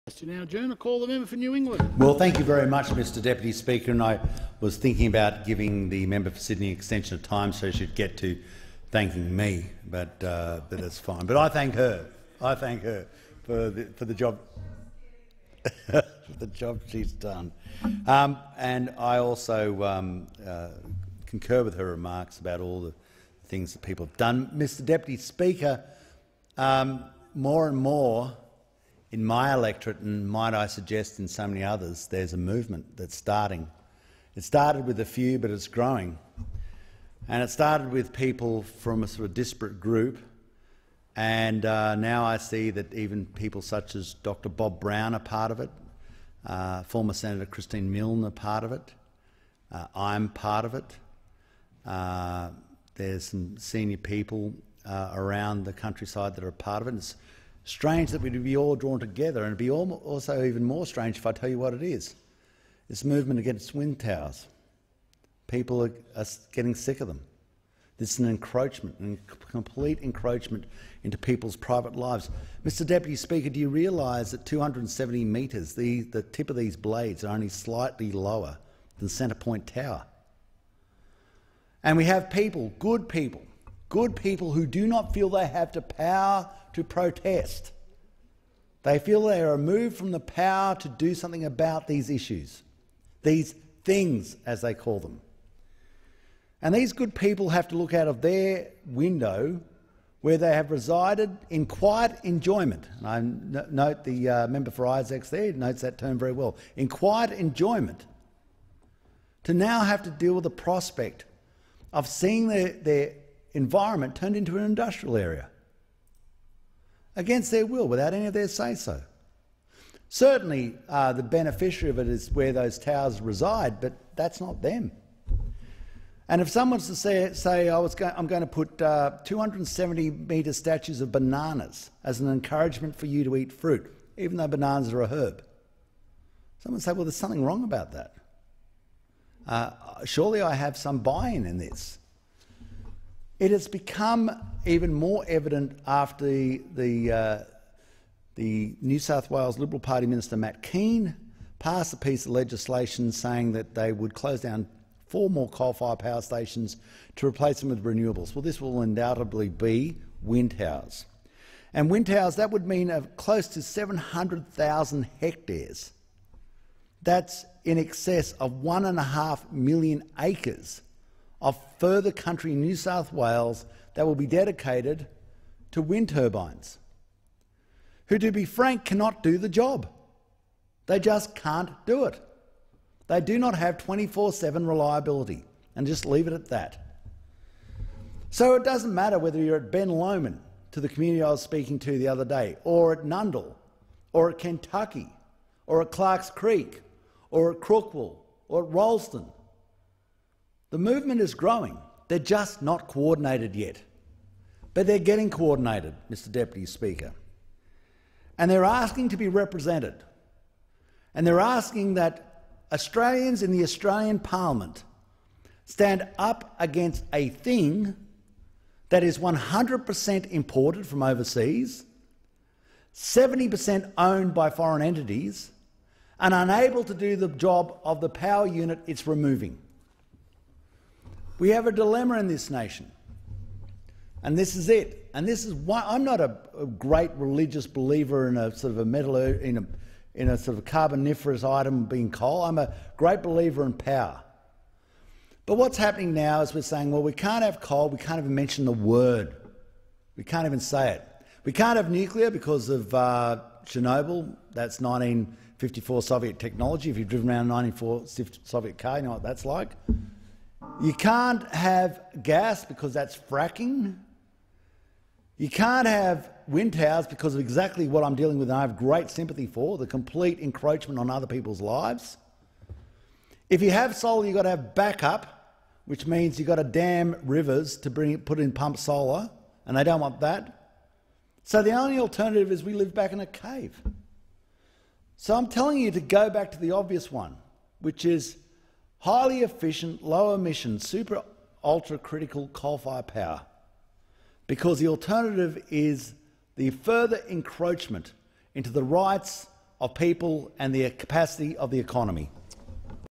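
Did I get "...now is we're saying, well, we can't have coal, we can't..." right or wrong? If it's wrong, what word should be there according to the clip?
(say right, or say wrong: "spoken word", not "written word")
right.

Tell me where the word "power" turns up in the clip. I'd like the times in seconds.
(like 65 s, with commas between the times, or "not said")
85 s, 90 s, 155 s, 228 s, 243 s, 293 s.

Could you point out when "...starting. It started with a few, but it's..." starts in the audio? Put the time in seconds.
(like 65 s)
33 s.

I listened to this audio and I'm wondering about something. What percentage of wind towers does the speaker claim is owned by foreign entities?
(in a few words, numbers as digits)
70%.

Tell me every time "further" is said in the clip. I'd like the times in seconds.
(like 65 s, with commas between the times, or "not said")
171 s, 296 s.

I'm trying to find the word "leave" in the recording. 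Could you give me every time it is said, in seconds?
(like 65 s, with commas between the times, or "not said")
186 s.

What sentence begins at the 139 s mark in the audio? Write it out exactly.
Uh, surely I have some buy in in this.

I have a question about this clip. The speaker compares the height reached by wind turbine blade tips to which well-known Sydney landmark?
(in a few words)
Centrepoint Tower.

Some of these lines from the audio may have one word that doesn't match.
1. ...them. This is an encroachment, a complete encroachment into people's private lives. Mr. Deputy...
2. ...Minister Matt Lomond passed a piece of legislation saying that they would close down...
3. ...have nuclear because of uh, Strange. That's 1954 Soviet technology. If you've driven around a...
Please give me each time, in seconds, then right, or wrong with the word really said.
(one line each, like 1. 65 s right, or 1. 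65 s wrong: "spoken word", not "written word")
1. 67 s right
2. 150 s wrong: "Kean", not "Lomond"
3. 251 s wrong: "Chernobyl", not "Strange".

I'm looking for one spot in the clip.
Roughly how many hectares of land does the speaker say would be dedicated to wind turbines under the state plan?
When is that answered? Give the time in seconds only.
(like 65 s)
163 s.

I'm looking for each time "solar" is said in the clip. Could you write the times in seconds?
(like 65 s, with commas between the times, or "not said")
273 s, 278 s.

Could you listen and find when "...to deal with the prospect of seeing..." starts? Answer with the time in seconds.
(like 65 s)
110 s.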